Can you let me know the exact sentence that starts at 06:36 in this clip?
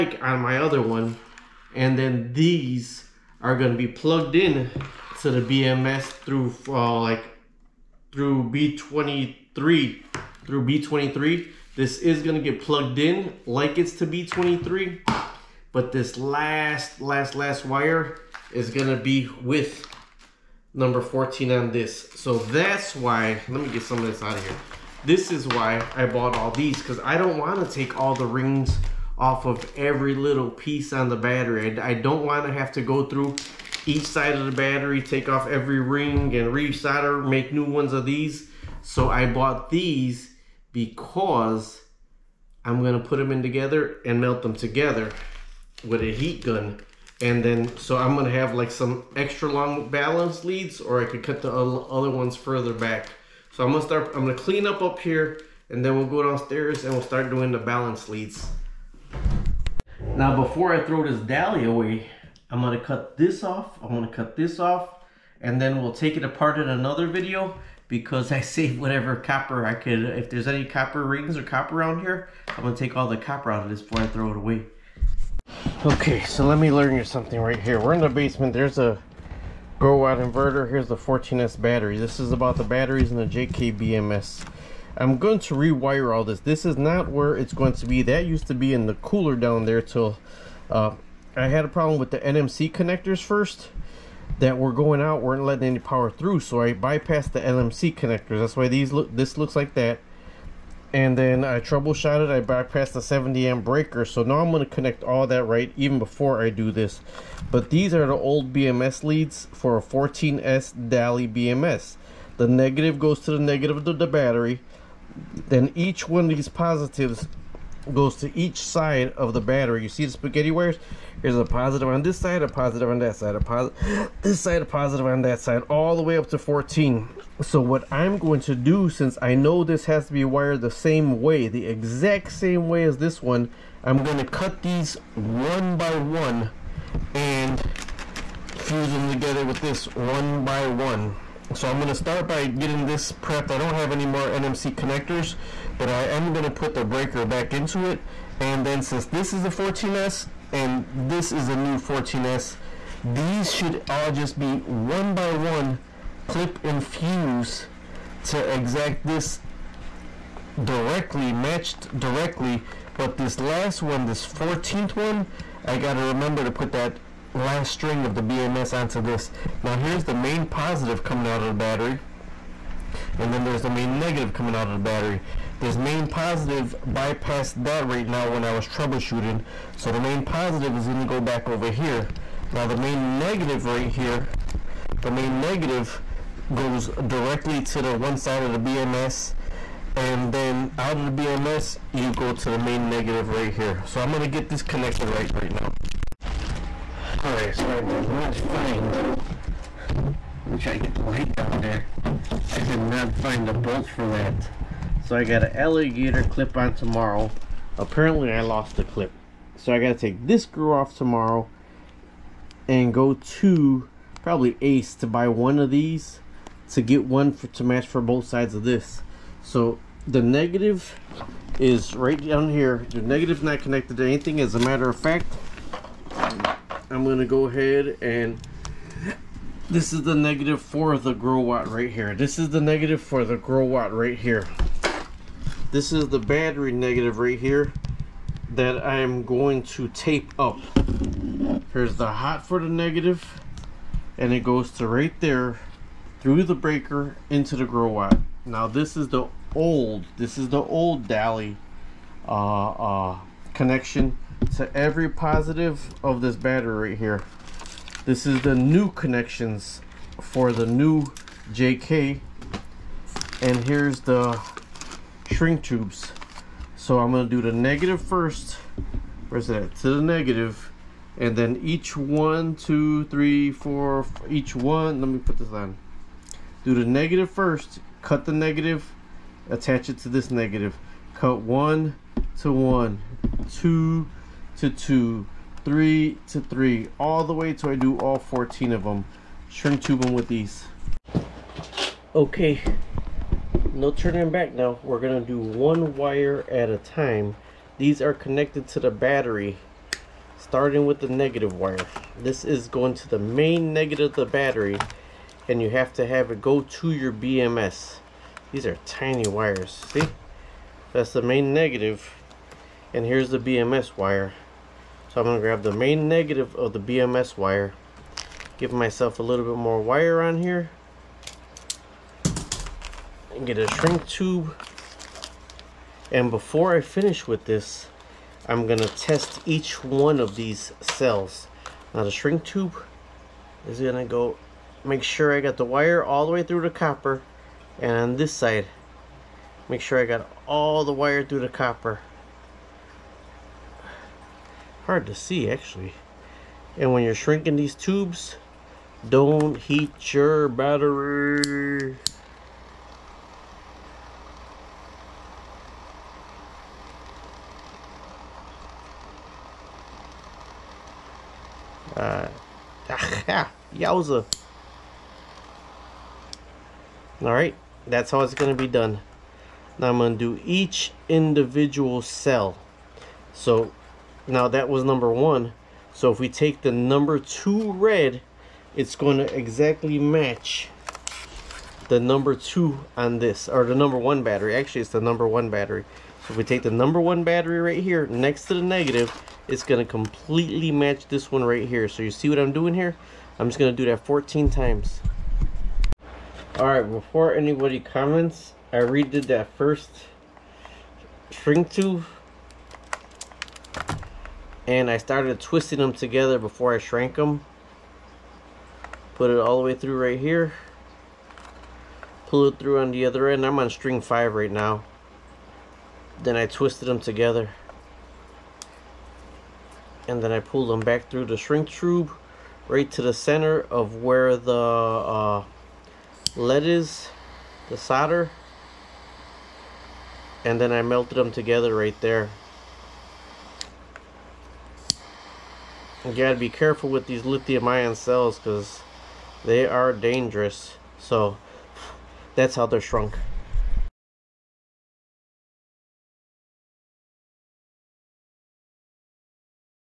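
Alright, before anybody comments, I redid that first string tube.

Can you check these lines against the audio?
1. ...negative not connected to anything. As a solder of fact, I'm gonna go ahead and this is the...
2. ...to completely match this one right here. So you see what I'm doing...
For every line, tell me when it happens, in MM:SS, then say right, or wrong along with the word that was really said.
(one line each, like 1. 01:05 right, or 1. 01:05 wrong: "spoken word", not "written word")
1. 03:43 wrong: "matter", not "solder"
2. 06:29 right.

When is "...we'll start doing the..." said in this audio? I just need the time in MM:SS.
00:56.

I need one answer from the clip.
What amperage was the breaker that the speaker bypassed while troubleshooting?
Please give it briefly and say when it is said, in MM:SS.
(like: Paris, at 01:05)
70 amp, at 01:43.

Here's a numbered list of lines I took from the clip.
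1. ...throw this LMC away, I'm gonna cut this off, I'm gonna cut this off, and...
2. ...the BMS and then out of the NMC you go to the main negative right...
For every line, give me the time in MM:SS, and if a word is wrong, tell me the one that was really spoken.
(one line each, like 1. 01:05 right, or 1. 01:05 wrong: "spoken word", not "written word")
1. 01:00 wrong: "Daly", not "LMC"
2. 03:08 wrong: "BMS", not "NMC".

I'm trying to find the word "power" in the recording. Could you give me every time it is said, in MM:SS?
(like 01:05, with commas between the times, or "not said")
01:35.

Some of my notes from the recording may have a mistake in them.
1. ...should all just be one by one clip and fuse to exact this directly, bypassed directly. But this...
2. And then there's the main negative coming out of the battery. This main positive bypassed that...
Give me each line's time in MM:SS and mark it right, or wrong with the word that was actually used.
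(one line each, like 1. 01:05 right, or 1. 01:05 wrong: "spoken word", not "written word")
1. 02:33 wrong: "matched", not "bypassed"
2. 02:53 right.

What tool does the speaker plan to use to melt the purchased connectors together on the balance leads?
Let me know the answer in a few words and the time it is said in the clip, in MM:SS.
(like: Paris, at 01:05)
Heat gun, at 00:46.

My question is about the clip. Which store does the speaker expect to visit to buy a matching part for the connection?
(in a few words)
Ace.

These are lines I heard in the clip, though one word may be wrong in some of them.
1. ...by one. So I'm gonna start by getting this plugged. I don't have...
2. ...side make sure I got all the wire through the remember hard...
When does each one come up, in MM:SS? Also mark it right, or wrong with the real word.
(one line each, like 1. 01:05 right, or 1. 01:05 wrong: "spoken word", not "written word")
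1. 02:20 wrong: "prepped", not "plugged"
2. 05:38 wrong: "copper", not "remember".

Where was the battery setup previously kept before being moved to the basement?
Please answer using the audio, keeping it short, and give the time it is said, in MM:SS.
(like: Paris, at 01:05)
In the cooler, at 01:28.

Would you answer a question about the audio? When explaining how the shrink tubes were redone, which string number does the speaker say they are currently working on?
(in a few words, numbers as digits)
5.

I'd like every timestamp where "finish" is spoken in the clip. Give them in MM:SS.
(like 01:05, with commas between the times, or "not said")
05:26.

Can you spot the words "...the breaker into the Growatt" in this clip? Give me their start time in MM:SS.
04:06.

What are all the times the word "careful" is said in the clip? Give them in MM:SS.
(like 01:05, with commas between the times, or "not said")
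07:16.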